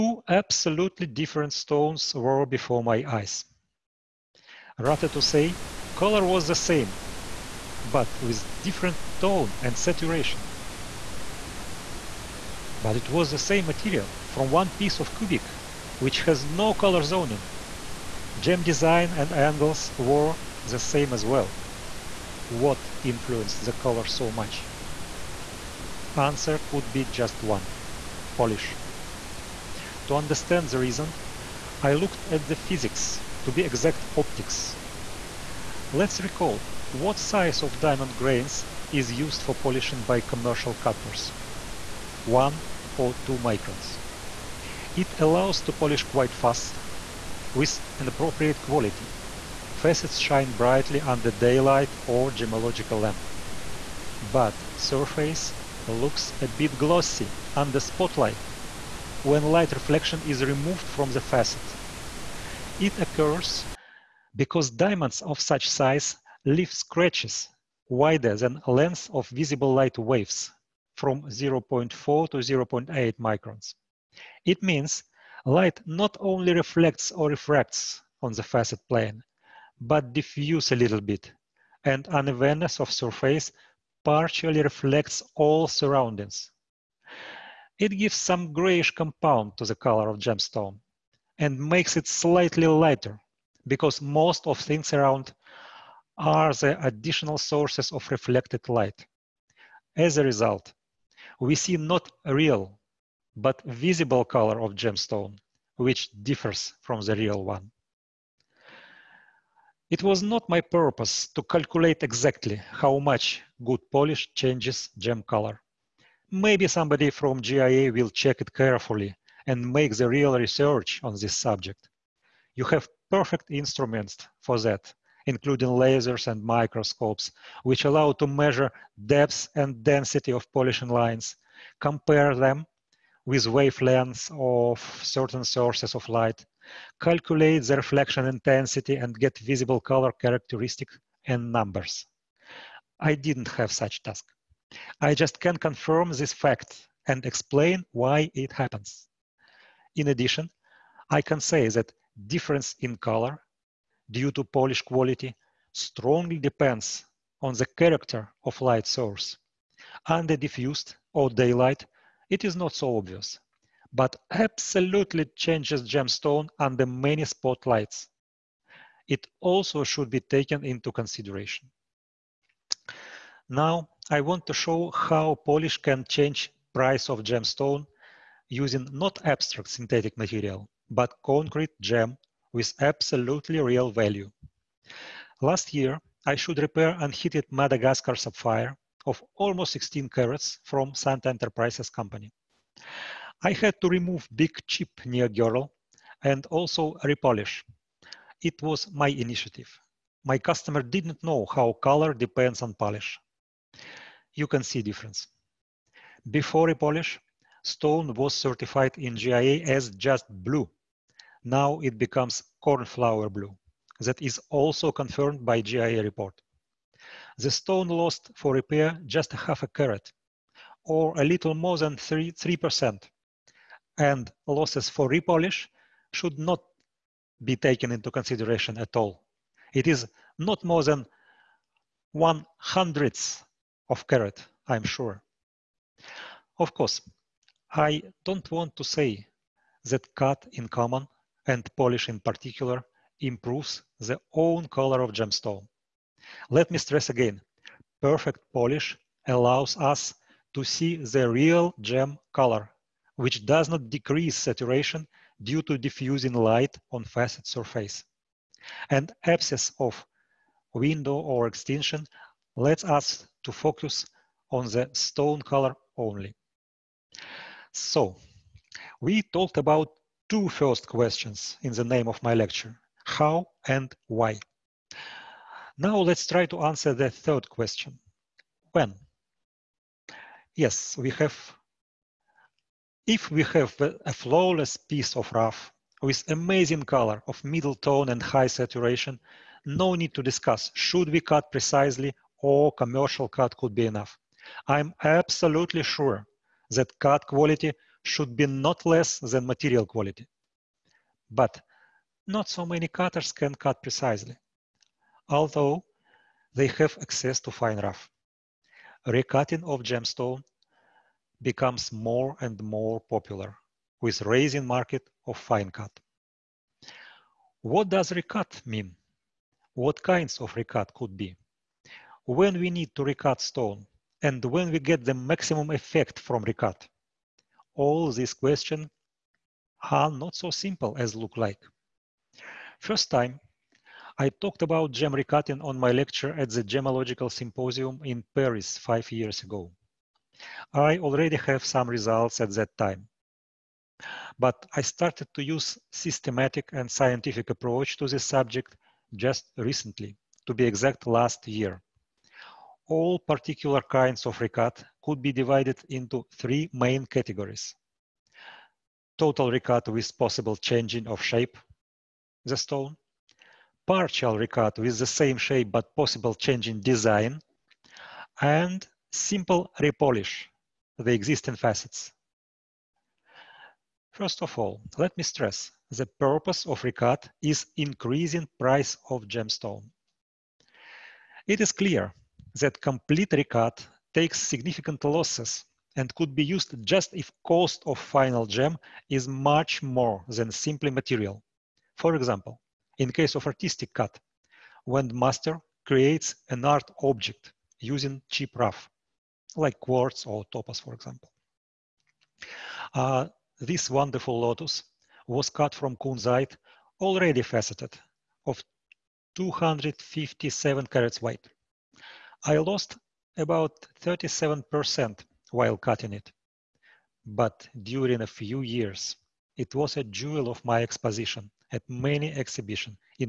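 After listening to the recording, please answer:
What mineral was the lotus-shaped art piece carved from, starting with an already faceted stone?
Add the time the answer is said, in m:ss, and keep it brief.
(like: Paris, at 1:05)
kunzite, at 6:45.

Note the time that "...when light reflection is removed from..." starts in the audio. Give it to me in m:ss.
0:59.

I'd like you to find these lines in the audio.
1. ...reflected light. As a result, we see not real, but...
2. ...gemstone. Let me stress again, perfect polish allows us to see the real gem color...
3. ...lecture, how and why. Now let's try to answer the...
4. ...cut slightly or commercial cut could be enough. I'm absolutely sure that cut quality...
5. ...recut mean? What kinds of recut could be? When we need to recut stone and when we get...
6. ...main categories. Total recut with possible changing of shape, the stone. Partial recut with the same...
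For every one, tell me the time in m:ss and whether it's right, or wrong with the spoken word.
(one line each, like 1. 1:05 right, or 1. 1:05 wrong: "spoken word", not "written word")
1. 1:38 right
2. 4:05 right
3. 4:32 right
4. 4:51 wrong: "precisely", not "slightly"
5. 5:18 right
6. 5:56 right.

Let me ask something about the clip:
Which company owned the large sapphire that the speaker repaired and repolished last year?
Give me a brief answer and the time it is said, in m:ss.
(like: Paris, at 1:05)
Santa Enterprises, at 3:10.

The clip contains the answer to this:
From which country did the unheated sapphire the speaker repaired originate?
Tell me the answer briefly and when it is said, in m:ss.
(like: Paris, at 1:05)
Madagascar, at 3:07.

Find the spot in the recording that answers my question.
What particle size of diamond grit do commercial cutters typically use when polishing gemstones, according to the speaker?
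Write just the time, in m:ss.
0:42.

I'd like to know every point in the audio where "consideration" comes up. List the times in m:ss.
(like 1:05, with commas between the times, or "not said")
2:50, 3:48.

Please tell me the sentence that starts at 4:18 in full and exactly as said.
An absence of window or extinction lets us to focus on the stone color only.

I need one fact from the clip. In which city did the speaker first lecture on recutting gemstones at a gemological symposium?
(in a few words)
Paris.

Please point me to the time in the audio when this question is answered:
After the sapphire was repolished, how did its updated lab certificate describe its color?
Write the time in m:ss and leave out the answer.
3:32.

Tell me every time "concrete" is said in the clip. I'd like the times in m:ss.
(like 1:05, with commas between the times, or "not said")
3:01.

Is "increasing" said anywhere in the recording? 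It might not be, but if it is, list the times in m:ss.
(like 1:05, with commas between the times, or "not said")
6:17.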